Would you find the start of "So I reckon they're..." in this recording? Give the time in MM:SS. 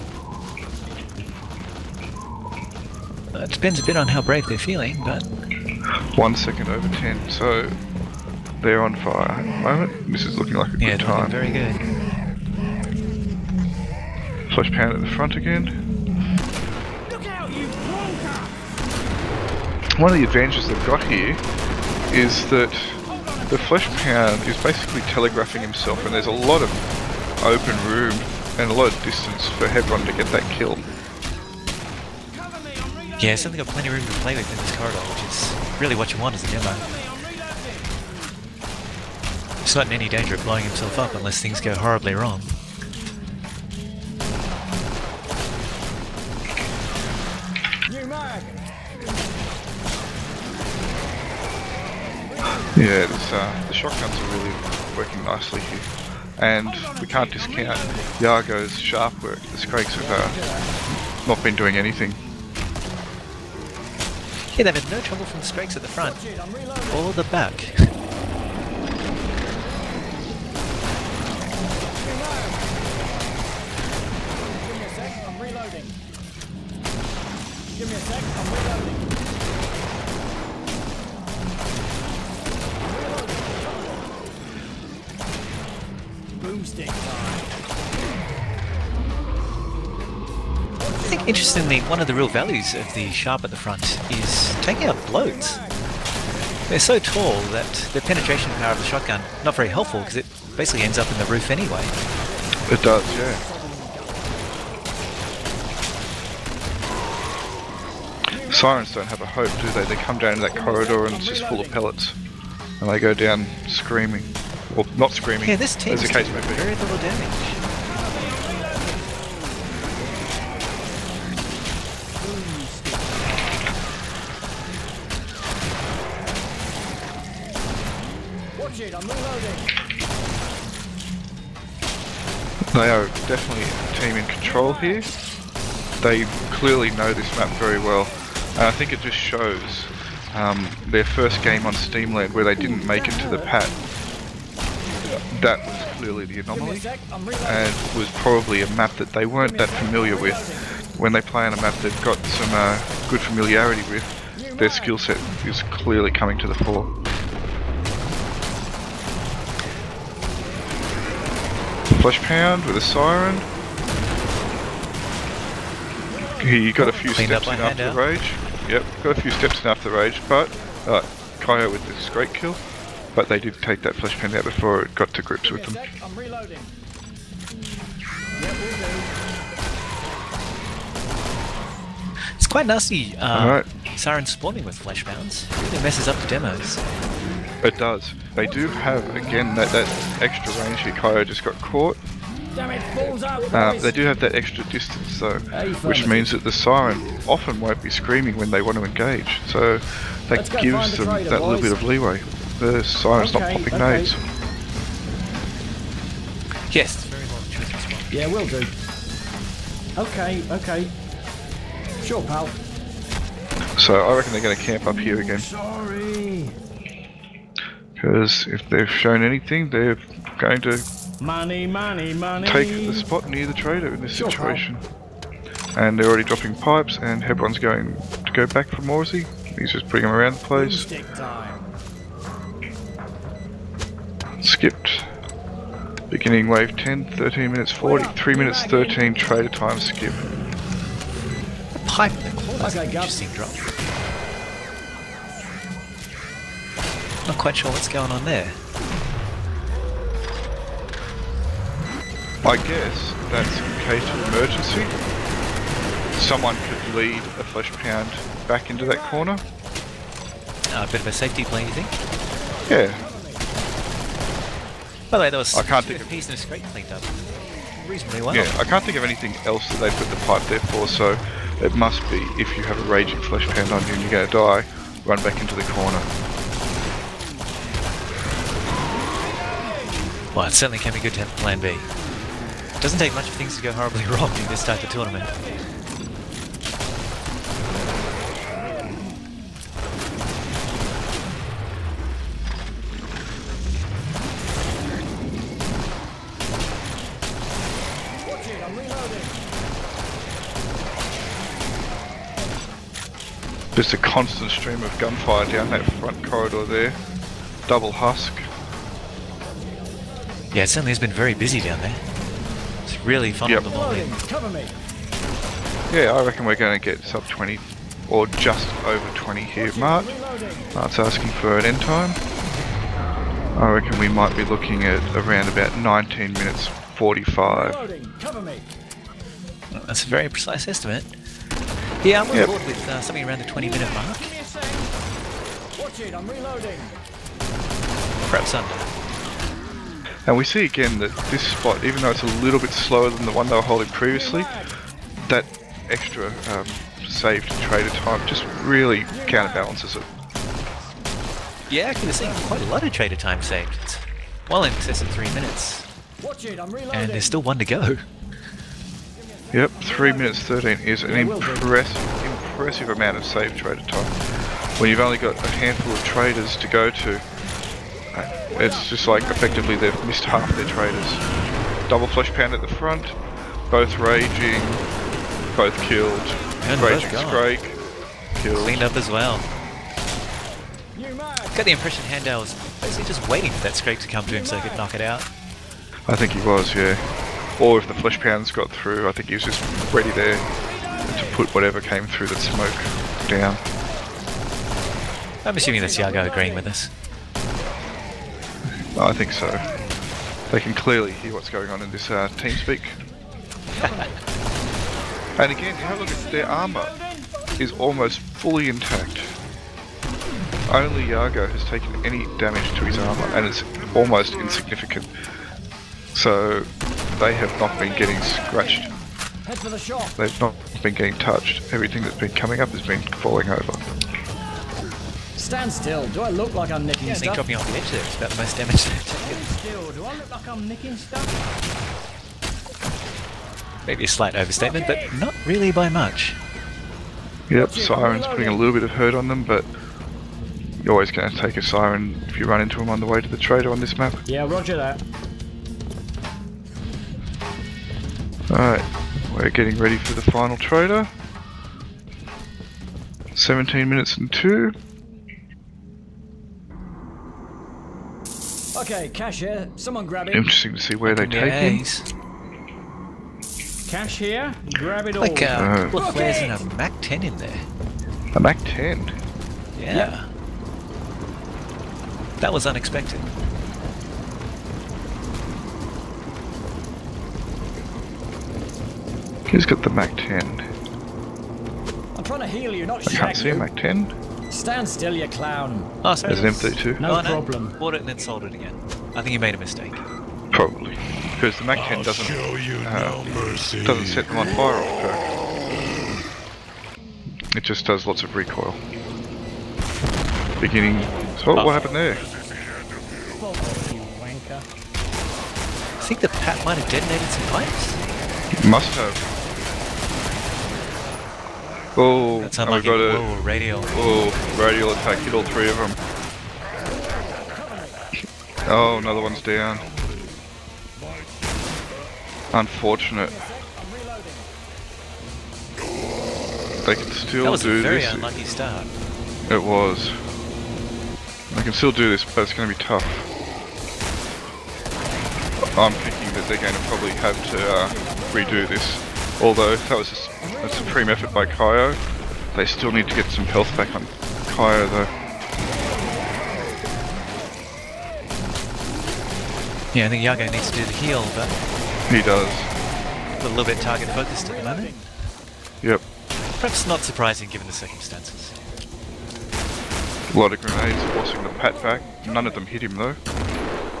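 03:33.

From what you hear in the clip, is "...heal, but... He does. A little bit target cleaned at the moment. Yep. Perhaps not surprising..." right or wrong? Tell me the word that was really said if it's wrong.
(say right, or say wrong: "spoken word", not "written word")
wrong: "focused", not "cleaned".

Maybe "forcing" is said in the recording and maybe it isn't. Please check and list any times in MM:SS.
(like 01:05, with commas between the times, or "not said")
09:21.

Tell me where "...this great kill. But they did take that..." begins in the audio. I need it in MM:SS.
02:51.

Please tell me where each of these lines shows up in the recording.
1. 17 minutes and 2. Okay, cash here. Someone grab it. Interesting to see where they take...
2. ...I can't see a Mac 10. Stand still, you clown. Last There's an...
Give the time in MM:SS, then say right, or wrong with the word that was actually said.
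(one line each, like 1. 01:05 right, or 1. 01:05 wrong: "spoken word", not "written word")
1. 07:33 right
2. 08:03 right.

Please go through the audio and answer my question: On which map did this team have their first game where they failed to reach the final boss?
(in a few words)
Steamland.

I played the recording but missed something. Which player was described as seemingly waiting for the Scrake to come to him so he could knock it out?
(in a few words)
Handel.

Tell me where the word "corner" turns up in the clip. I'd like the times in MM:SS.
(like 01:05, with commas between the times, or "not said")
04:02, 04:18, 04:35.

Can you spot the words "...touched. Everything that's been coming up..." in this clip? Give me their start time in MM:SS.
07:01.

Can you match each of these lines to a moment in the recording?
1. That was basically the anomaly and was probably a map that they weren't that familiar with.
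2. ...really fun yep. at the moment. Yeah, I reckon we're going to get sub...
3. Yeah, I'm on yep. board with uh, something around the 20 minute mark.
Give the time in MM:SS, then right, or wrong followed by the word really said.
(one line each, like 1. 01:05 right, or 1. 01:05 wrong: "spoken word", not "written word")
1. 02:25 wrong: "clearly", not "basically"
2. 05:12 right
3. 05:32 right.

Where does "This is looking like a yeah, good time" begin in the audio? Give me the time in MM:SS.
00:10.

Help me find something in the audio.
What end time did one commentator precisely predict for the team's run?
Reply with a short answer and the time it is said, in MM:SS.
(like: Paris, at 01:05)
19 minutes 45, at 05:25.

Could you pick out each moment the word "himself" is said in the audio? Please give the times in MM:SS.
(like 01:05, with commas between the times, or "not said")
00:25, 00:40.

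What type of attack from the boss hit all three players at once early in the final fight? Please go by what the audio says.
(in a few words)
radial attack.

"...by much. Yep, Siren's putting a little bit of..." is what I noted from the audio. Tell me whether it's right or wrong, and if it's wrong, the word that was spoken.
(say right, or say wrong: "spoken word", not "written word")
right.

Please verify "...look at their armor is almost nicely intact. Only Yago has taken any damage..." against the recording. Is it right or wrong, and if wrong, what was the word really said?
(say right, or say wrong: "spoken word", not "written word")
wrong: "fully", not "nicely".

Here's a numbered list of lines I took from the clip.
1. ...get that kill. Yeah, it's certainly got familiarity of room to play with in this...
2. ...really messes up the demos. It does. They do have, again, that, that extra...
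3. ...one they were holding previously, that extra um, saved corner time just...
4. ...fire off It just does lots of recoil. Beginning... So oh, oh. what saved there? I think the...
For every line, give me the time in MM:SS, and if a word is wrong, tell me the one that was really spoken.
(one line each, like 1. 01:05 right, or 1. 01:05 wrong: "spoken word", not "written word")
1. 00:30 wrong: "plenty", not "familiarity"
2. 03:05 right
3. 05:43 wrong: "trader", not "corner"
4. 08:14 wrong: "happened", not "saved".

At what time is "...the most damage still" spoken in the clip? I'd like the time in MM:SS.
07:08.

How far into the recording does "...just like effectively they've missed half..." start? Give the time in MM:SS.
06:08.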